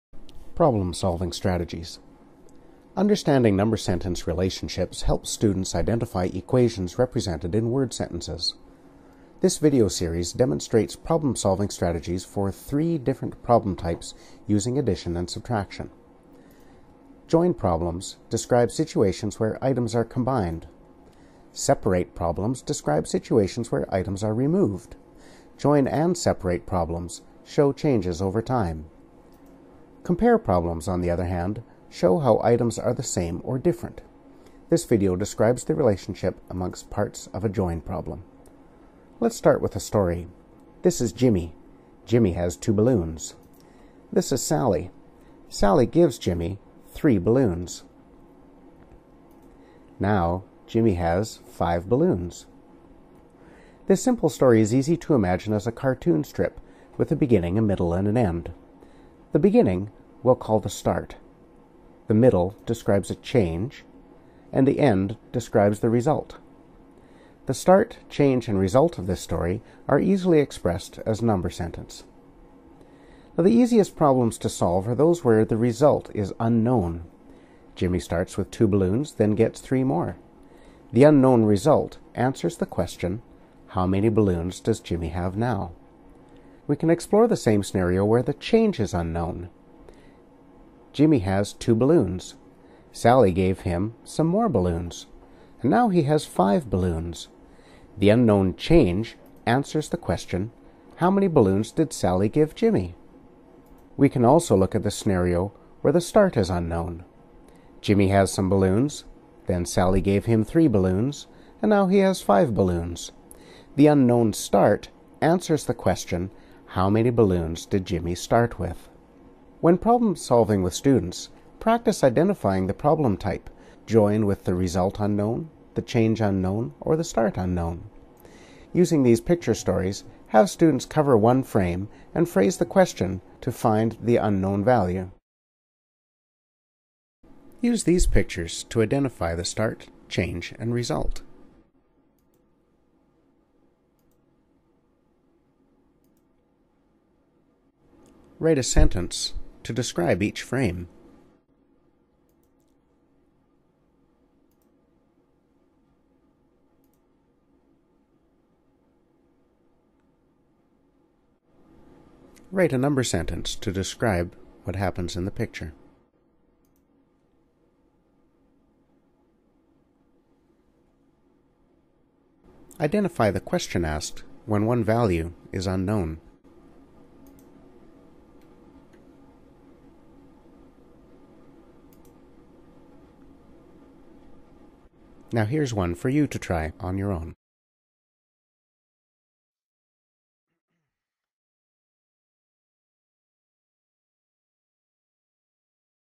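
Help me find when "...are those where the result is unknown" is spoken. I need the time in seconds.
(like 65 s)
74 s.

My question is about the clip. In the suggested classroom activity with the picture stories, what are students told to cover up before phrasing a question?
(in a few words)
one frame.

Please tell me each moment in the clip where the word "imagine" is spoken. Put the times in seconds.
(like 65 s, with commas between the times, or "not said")
55 s.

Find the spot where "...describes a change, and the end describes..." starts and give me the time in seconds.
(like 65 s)
62 s.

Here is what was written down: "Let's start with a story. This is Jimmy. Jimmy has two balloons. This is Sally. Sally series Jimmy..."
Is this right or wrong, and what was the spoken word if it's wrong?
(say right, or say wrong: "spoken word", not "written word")
wrong: "gives", not "series".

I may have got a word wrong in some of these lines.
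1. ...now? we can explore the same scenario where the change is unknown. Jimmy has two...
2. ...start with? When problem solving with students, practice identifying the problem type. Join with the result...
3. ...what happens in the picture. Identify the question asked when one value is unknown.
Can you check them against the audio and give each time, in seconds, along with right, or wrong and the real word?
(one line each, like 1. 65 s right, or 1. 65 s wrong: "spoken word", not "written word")
1. 85 s right
2. 118 s right
3. 164 s right.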